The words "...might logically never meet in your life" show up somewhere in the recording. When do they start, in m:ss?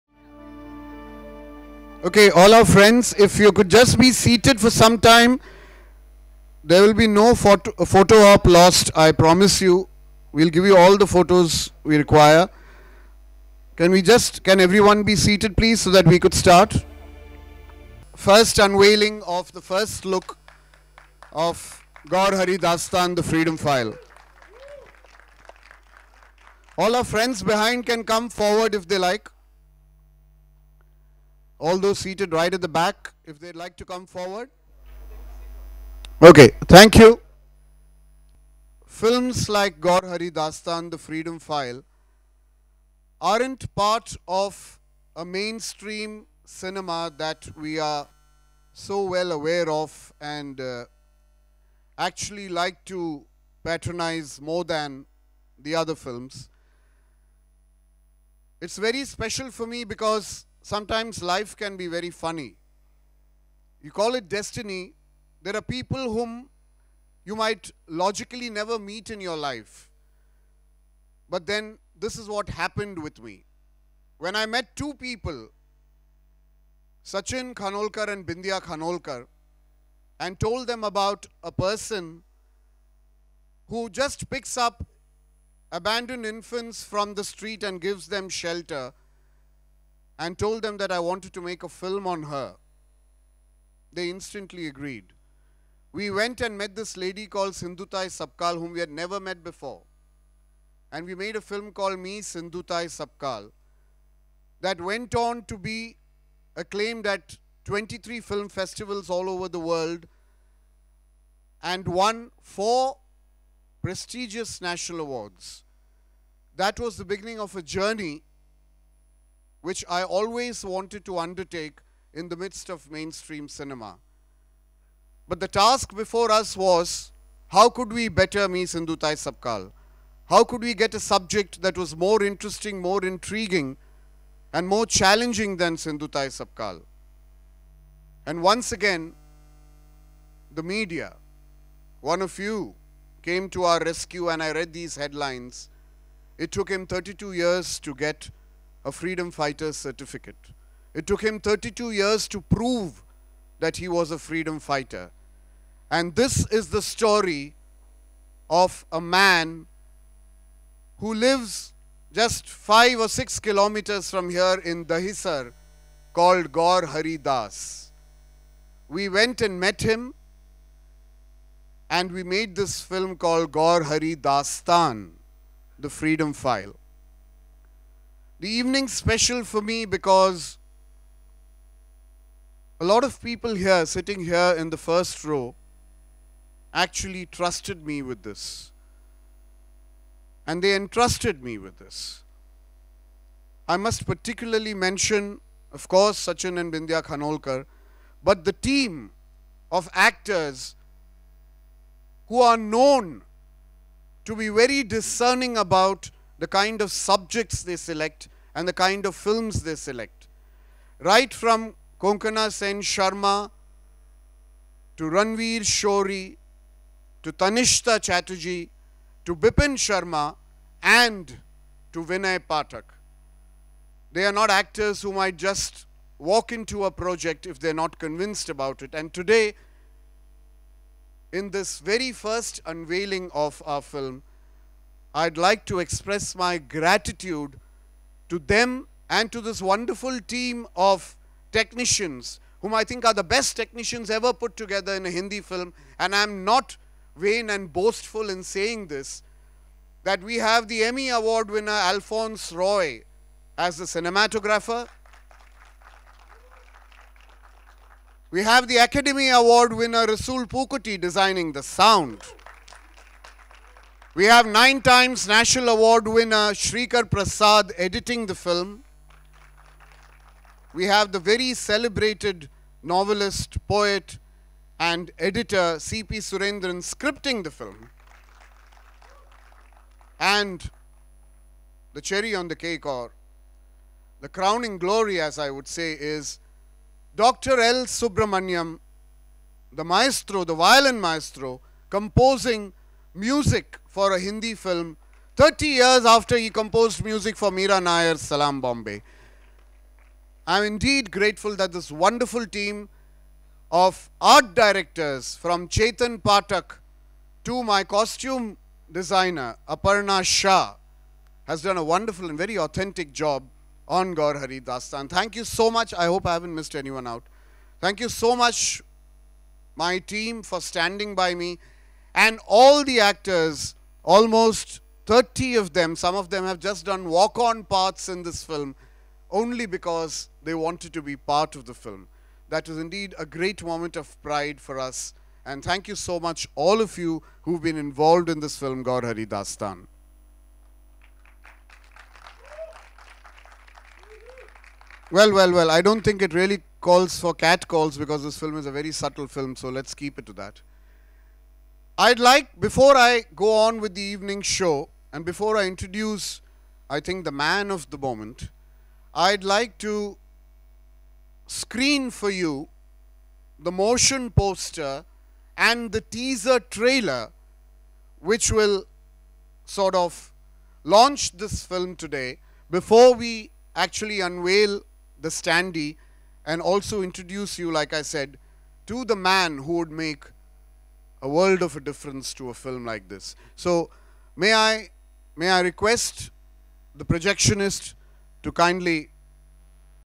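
1:07.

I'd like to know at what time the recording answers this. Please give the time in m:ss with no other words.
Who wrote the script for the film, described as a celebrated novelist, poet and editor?
4:35.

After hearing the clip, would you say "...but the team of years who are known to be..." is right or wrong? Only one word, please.
wrong.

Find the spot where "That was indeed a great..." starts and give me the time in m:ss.
5:32.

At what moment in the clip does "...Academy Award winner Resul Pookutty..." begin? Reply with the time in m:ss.
4:18.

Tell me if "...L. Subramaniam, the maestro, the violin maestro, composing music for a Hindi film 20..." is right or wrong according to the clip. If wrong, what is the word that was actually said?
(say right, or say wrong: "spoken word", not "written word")
wrong: "30", not "20".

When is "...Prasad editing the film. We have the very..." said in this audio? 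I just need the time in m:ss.
4:27.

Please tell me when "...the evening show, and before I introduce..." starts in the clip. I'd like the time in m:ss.
5:53.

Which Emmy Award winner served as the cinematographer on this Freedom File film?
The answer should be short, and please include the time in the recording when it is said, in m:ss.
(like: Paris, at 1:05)
Alphonse Roy, at 4:11.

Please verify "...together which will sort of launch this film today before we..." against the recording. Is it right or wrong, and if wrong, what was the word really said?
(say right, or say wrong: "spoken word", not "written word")
wrong: "trailer", not "together".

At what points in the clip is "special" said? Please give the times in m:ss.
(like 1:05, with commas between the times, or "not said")
0:59, 2:58.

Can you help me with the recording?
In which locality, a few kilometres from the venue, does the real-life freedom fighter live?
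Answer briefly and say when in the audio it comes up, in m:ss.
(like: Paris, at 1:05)
Dahisar, at 2:44.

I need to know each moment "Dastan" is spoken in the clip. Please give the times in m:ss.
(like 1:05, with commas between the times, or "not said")
0:22, 0:40, 2:54, 5:14, 5:39.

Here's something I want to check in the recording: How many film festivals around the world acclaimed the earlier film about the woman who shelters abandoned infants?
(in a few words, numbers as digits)
23.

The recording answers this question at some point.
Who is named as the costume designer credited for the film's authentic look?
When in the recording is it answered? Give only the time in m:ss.
5:09.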